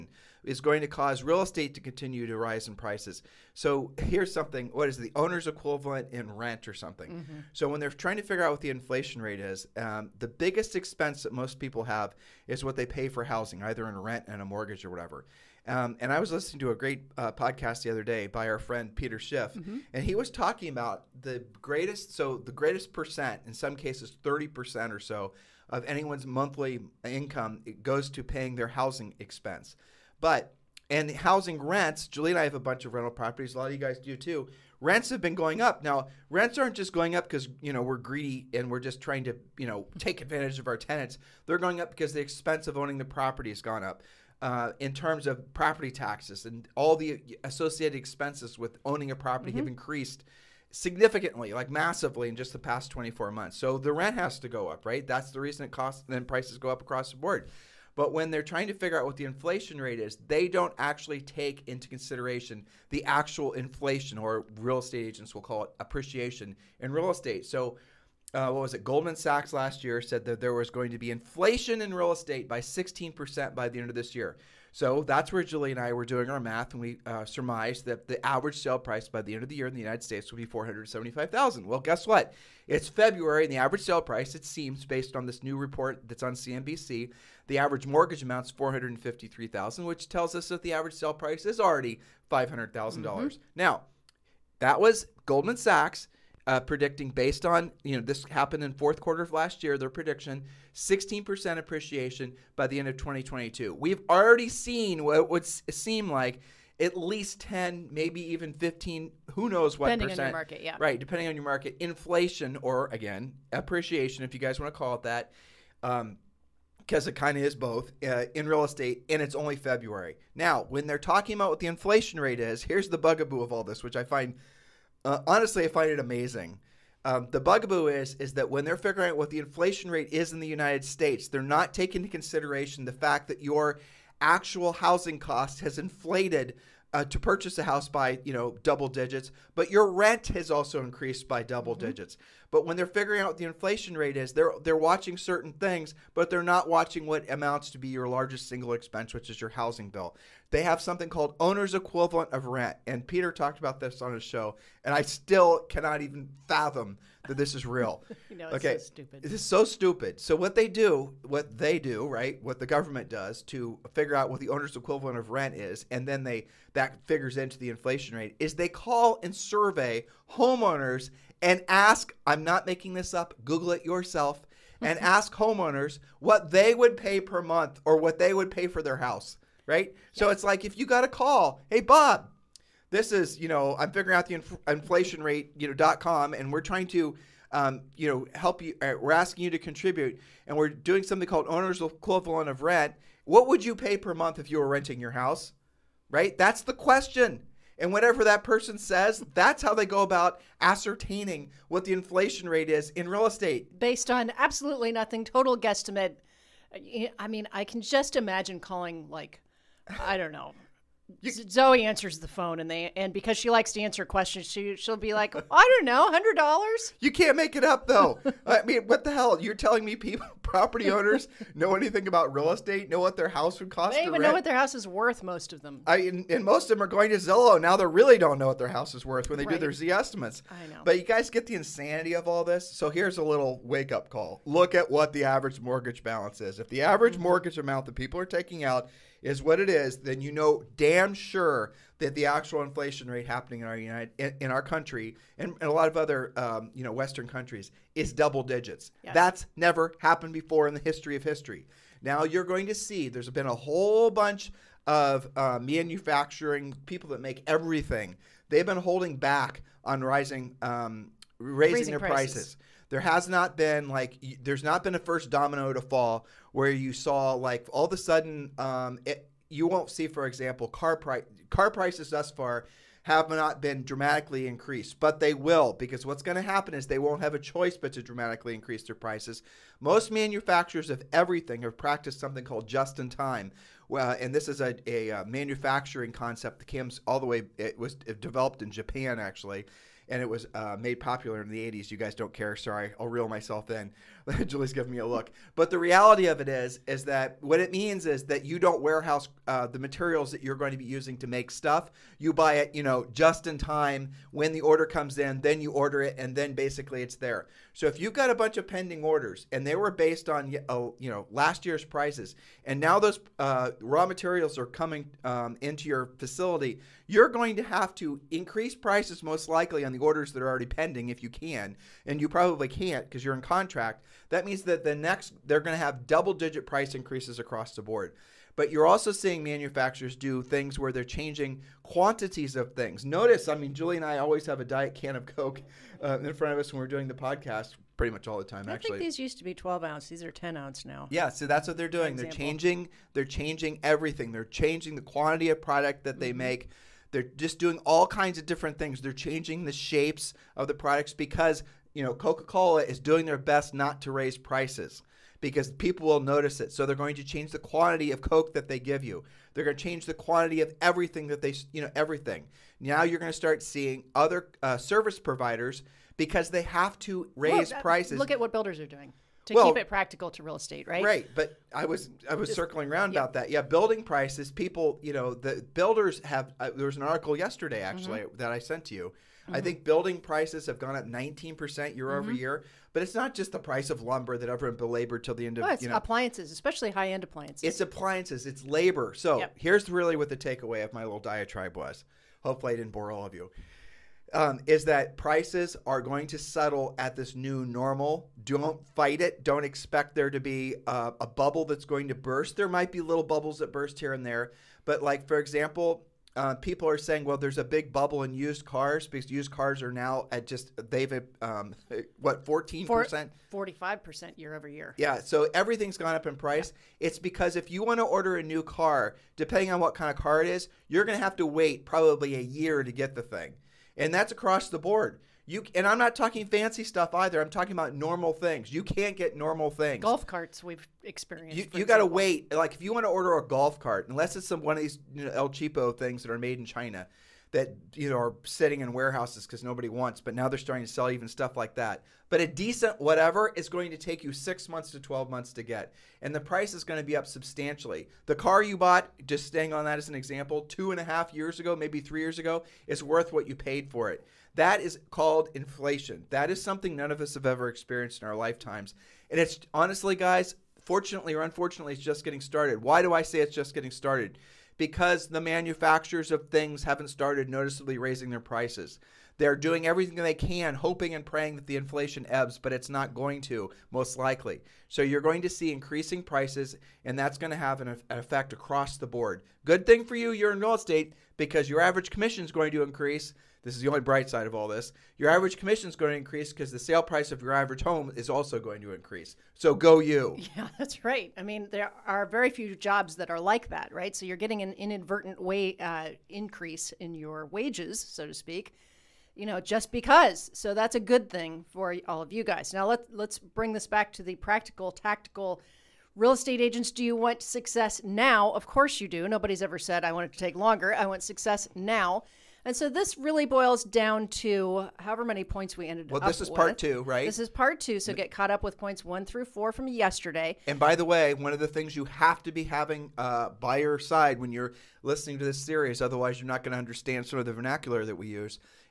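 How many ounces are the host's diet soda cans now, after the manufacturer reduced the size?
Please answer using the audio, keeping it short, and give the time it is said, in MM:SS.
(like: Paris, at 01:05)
10, at 05:40.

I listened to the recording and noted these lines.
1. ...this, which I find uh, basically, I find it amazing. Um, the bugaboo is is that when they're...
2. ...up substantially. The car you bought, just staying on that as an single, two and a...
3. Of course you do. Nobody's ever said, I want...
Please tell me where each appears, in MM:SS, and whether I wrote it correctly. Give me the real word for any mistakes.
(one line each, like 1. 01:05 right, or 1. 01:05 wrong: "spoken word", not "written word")
1. 02:03 wrong: "honestly", not "basically"
2. 07:27 wrong: "example", not "single"
3. 08:28 right.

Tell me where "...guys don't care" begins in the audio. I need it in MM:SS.
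04:51.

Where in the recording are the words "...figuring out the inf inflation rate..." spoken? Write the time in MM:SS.
03:03.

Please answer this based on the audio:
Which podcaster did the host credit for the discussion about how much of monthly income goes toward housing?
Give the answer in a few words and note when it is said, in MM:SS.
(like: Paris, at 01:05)
Peter Schiff, at 00:18.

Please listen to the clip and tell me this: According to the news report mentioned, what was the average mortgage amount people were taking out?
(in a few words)
453,000.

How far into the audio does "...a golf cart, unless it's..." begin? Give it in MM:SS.
07:13.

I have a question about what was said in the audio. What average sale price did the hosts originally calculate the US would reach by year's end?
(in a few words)
475,000.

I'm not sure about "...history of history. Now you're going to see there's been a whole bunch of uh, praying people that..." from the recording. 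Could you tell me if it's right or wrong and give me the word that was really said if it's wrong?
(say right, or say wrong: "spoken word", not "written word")
wrong: "manufacturing", not "praying".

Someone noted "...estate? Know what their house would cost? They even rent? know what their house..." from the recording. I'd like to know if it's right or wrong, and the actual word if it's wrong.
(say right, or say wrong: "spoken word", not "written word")
right.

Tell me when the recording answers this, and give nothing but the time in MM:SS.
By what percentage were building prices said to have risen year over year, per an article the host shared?
06:21.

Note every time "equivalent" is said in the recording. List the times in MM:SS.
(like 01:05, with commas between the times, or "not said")
00:05, 02:31, 02:44, 03:11.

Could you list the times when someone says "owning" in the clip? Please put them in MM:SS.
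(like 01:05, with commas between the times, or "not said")
00:42, 00:48.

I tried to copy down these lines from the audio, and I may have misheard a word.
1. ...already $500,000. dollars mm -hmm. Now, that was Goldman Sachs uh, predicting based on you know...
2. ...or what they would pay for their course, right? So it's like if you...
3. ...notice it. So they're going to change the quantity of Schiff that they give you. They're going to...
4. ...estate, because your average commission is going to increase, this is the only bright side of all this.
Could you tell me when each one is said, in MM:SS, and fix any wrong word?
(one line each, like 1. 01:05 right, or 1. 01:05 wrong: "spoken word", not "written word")
1. 01:31 right
2. 02:57 wrong: "house", not "course"
3. 05:56 wrong: "Coke", not "Schiff"
4. 08:00 right.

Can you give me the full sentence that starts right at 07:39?
And it's honestly, guys, fortunately or unfortunately, it's just getting started.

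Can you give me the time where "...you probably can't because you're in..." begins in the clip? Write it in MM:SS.
05:22.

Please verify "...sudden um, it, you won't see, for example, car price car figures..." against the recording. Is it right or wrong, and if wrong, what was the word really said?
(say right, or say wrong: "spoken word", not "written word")
wrong: "prices", not "figures".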